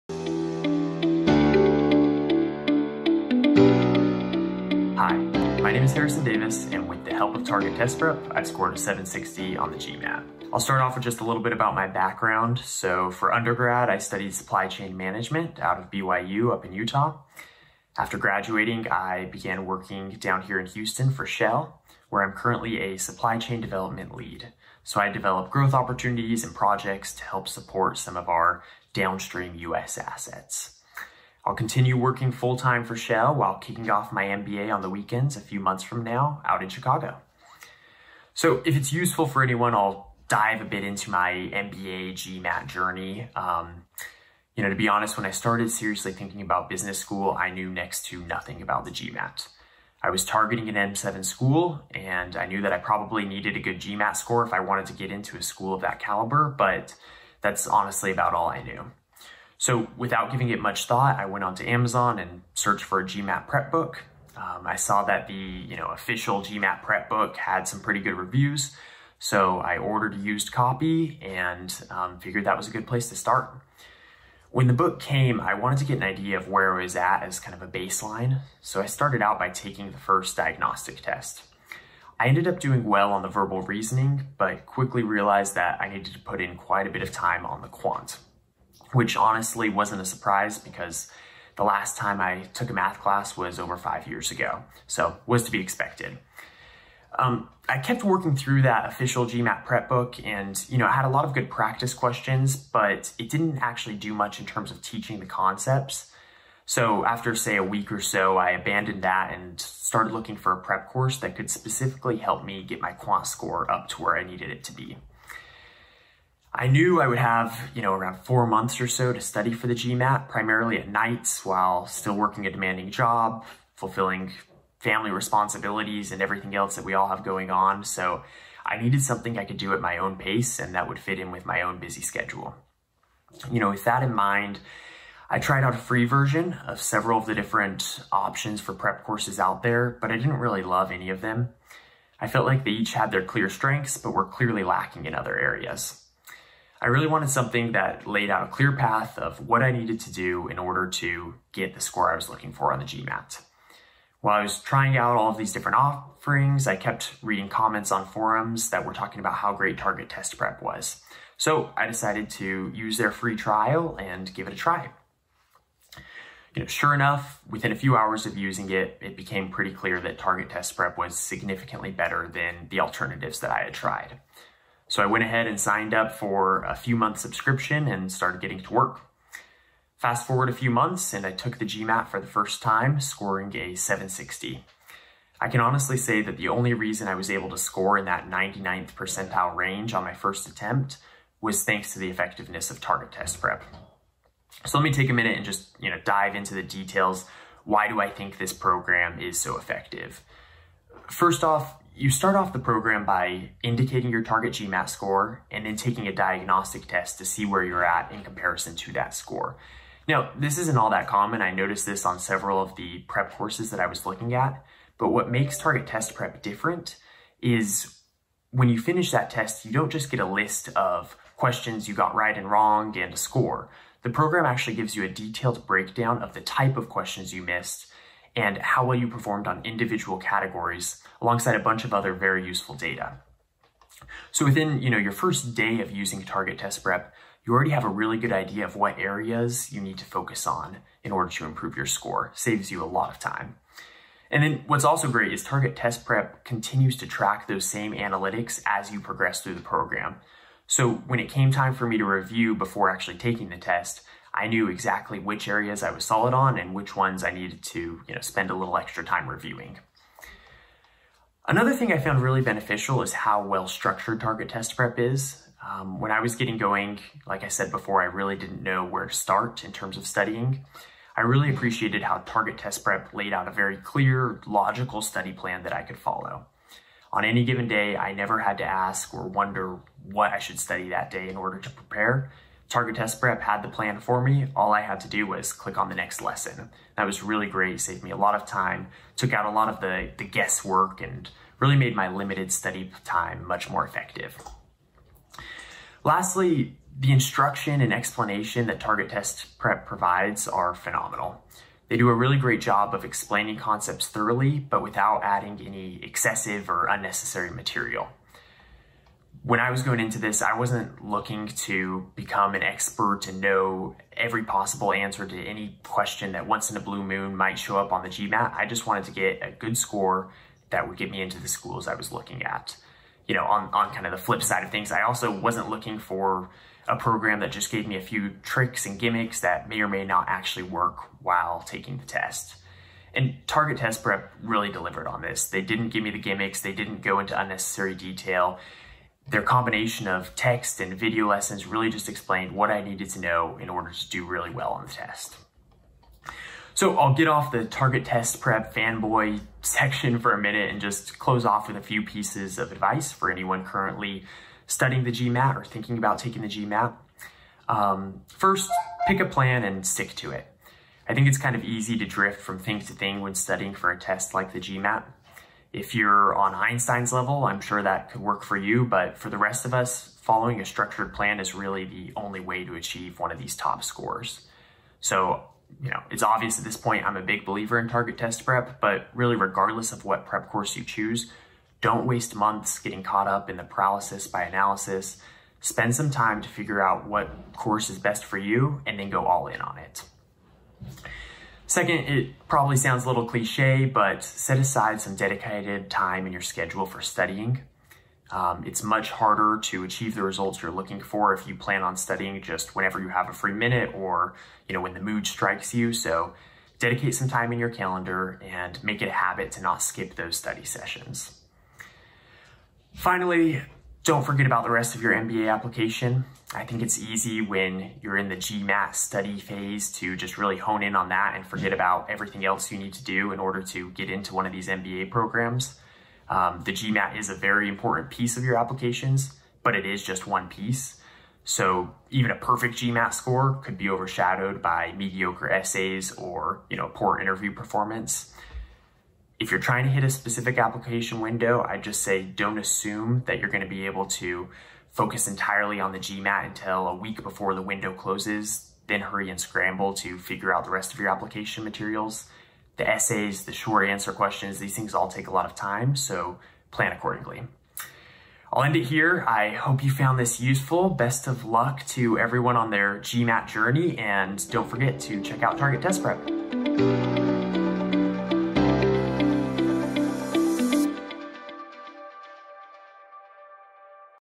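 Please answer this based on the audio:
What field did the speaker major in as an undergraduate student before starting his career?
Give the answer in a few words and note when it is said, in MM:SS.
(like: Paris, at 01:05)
Supply chain management, at 00:14.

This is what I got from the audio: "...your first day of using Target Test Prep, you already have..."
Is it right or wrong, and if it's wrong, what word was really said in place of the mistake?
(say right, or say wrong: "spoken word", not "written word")
right.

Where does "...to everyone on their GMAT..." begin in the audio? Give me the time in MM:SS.
07:41.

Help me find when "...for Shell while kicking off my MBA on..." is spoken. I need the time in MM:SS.
00:32.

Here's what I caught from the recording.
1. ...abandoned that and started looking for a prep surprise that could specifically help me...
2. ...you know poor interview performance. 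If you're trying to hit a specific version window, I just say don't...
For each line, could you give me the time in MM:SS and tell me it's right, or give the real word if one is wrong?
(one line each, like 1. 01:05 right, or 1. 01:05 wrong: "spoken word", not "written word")
1. 01:48 wrong: "course", not "surprise"
2. 07:16 wrong: "application", not "version".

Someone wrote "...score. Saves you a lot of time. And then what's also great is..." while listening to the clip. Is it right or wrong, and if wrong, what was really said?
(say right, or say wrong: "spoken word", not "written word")
right.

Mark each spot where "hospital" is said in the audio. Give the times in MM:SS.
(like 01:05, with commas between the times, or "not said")
not said.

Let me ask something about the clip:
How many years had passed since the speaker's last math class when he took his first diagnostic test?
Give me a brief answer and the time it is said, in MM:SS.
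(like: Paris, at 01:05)
5, at 01:33.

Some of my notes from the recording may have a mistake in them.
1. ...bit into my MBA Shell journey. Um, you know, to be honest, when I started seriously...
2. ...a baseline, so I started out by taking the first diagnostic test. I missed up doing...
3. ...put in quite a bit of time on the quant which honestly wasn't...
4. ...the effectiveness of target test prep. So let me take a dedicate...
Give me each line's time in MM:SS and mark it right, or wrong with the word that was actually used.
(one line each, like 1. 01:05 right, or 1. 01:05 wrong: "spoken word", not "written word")
1. 00:40 wrong: "GMAT", not "Shell"
2. 01:17 wrong: "ended", not "missed"
3. 01:26 right
4. 03:11 wrong: "minute", not "dedicate".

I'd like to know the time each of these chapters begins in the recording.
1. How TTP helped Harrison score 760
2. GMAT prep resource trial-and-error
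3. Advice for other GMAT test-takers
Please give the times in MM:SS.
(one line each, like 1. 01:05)
1. 03:00
2. 01:00
3. 05:45.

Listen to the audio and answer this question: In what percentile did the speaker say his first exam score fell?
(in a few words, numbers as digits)
99th percentile.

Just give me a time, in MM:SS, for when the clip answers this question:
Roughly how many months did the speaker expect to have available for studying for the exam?
01:58.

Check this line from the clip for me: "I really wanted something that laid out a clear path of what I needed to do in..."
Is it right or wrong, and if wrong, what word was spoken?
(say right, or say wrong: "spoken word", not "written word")
right.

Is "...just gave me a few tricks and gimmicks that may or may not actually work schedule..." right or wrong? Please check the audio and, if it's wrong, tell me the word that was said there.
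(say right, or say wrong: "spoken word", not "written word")
wrong: "while", not "schedule".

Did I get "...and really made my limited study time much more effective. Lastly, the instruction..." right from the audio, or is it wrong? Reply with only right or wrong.
right.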